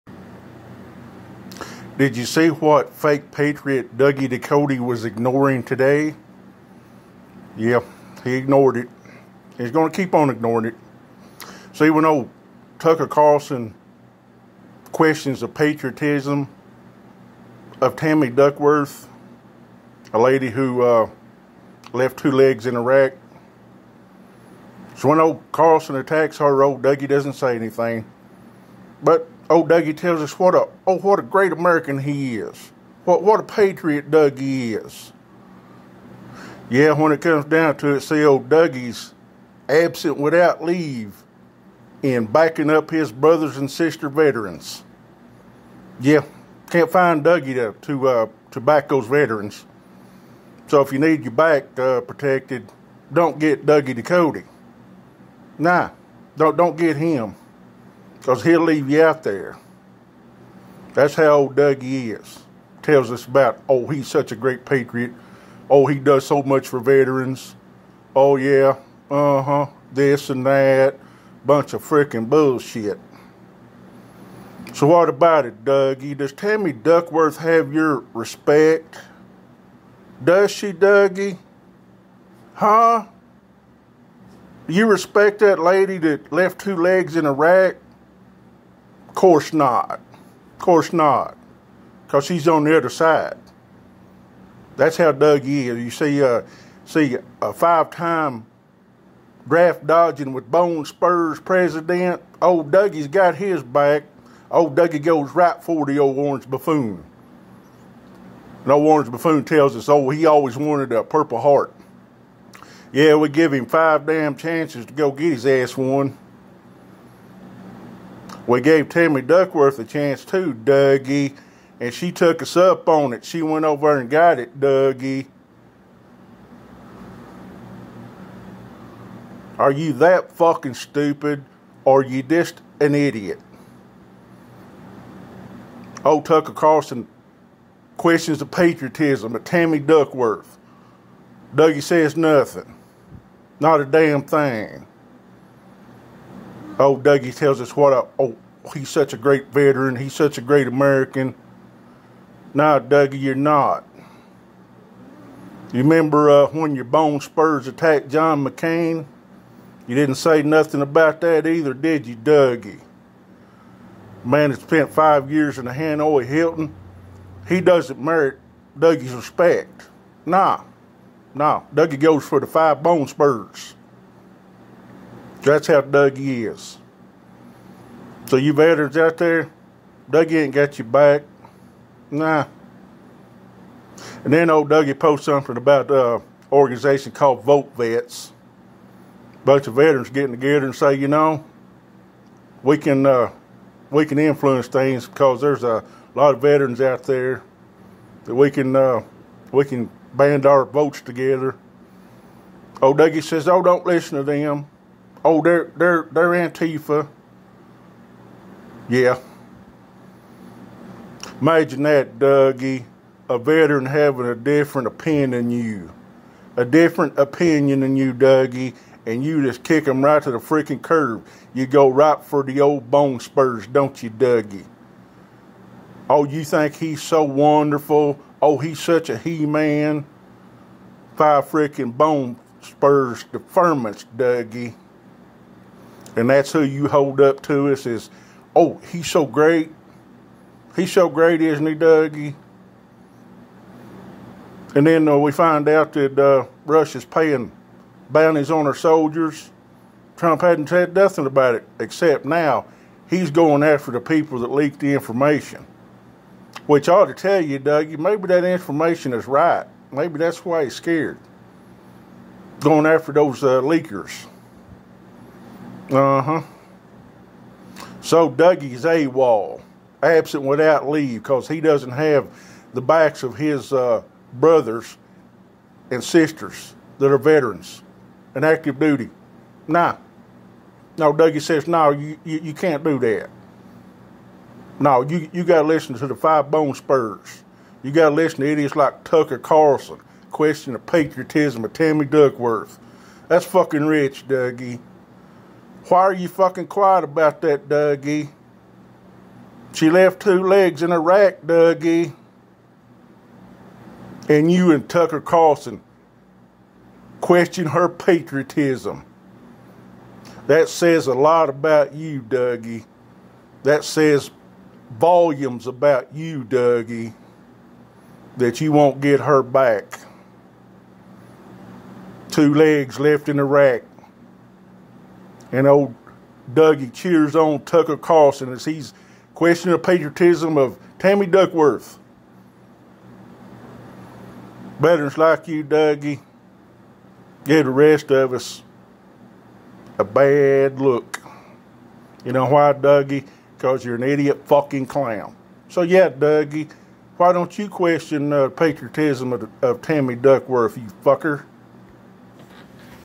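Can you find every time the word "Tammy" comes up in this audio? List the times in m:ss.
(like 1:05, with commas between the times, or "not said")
0:17, 1:16, 1:58, 2:19, 4:51, 5:30, 5:49.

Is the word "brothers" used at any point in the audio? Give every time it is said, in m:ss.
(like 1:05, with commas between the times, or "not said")
0:43, 4:34.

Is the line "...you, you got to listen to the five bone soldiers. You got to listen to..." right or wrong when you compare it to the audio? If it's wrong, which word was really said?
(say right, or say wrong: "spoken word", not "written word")
wrong: "spurs", not "soldiers".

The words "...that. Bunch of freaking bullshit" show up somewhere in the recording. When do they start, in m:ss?
1:10.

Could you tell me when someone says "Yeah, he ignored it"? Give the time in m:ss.
0:07.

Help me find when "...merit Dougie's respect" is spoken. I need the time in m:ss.
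2:48.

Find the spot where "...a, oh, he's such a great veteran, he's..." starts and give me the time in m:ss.
2:27.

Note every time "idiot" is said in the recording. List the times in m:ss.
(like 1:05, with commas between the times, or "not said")
2:12, 4:48, 5:44.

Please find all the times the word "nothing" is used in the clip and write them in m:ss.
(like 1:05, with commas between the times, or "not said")
2:22, 2:40, 4:10.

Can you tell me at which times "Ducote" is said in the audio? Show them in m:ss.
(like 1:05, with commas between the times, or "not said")
0:04, 0:54.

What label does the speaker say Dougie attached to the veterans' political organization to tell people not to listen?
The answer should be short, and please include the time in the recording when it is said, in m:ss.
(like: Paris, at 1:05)
Antifa, at 3:26.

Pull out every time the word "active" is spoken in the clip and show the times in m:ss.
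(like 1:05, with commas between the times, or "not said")
4:38.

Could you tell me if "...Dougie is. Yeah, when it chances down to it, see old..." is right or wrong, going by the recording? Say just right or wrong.
wrong.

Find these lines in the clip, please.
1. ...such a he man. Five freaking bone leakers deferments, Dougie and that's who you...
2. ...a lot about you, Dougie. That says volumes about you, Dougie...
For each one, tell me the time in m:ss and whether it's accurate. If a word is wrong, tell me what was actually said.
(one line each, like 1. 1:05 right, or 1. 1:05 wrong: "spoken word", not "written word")
1. 3:48 wrong: "spurs", not "leakers"
2. 5:11 right.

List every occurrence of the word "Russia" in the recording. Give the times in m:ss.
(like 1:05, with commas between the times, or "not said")
4:06.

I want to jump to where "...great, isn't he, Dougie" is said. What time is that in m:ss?
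4:01.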